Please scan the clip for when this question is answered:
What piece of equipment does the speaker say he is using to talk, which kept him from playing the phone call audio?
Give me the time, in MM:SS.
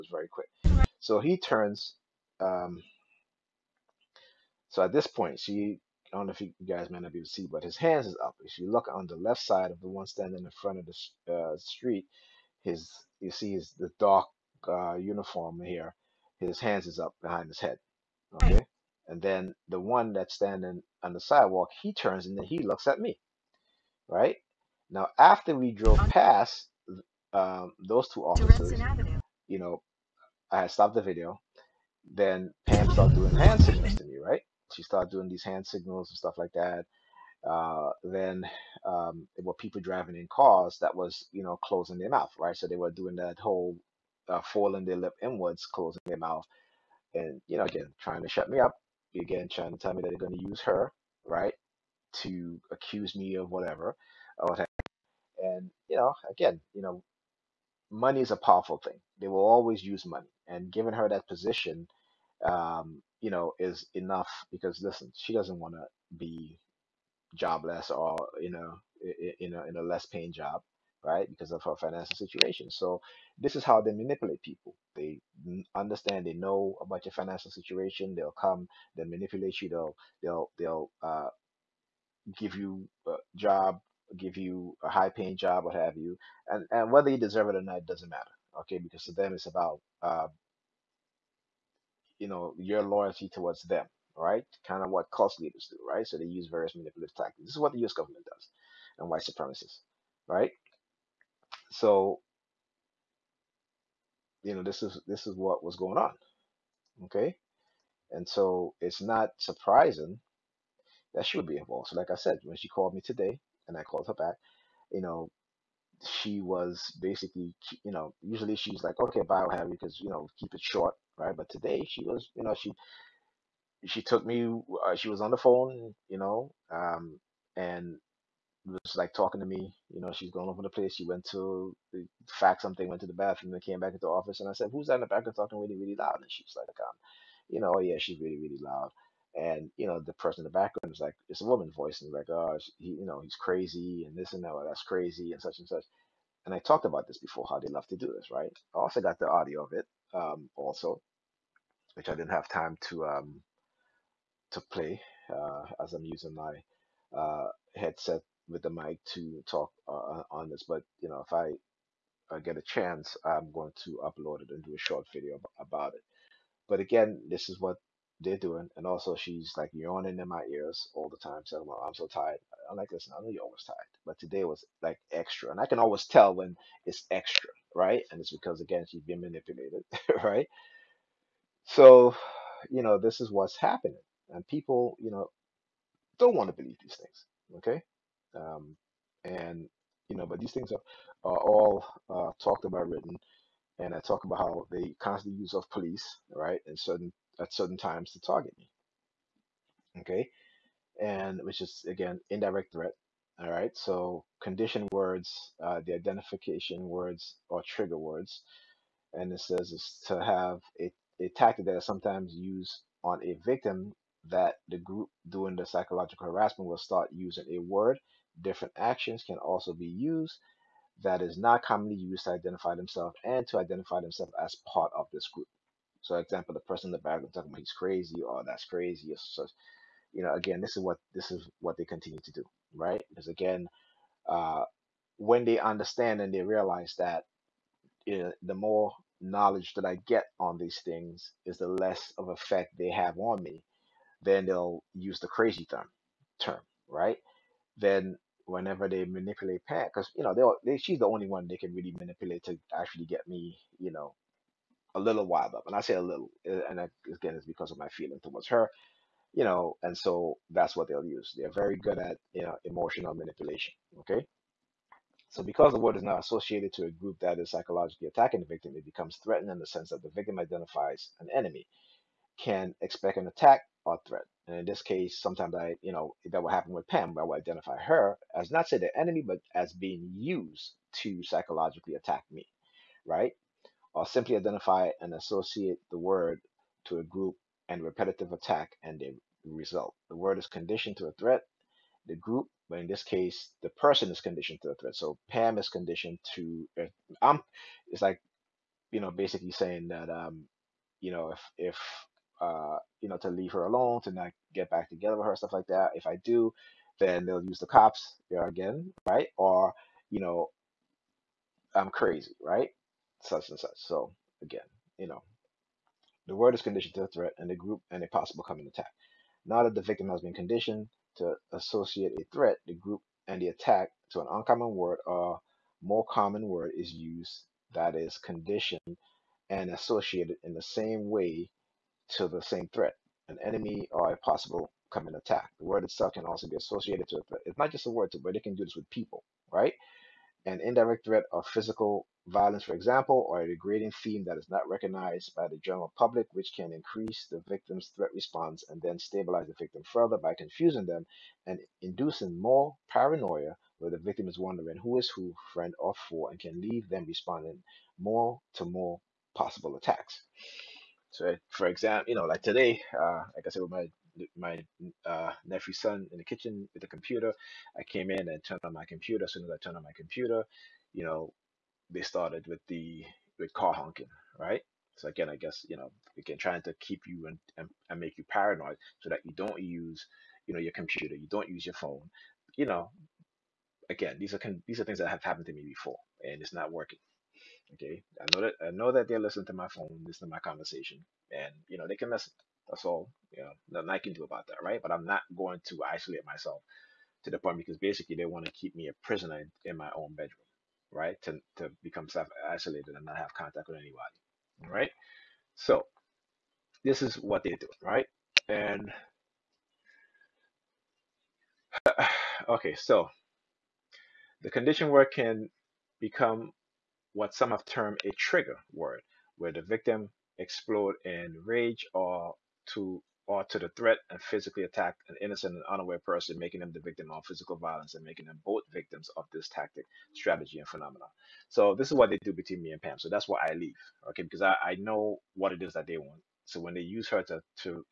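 02:37.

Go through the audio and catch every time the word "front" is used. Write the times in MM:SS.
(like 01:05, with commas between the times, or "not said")
00:10.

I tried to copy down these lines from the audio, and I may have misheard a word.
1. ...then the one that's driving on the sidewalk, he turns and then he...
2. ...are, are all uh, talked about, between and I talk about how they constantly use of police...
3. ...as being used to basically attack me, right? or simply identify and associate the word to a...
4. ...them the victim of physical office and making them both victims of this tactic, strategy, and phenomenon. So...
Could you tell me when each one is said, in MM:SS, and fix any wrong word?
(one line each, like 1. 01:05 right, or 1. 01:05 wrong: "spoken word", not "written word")
1. 00:19 wrong: "standing", not "driving"
2. 03:10 wrong: "written", not "between"
3. 04:39 wrong: "psychologically", not "basically"
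4. 07:06 wrong: "violence", not "office".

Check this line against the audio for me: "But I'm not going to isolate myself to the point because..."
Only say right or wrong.
right.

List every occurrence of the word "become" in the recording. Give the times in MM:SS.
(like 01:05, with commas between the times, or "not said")
04:28, 06:41, 06:55.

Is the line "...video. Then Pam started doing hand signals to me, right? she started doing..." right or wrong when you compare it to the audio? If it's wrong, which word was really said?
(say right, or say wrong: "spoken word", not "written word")
right.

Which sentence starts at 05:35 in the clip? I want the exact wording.
The word itself can also be associated to a threat.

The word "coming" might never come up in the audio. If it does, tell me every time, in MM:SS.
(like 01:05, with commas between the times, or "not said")
05:18, 05:34.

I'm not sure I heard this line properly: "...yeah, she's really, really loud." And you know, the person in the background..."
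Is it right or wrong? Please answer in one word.
right.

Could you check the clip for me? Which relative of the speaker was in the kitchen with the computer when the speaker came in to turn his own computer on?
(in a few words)
nephew's son.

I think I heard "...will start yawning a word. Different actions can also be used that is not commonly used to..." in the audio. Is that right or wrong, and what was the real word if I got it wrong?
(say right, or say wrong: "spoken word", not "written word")
wrong: "using", not "yawning".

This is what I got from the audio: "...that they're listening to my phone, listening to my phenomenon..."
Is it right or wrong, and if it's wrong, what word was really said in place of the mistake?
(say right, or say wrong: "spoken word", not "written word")
wrong: "conversation", not "phenomenon".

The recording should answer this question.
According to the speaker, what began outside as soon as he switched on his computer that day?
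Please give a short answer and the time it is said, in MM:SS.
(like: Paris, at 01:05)
car honking, at 06:13.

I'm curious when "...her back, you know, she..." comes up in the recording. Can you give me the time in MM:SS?
01:54.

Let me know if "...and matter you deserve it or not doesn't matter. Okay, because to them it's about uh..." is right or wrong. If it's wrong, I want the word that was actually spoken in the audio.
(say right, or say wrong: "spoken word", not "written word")
wrong: "whether", not "matter".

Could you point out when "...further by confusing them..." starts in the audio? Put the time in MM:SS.
05:49.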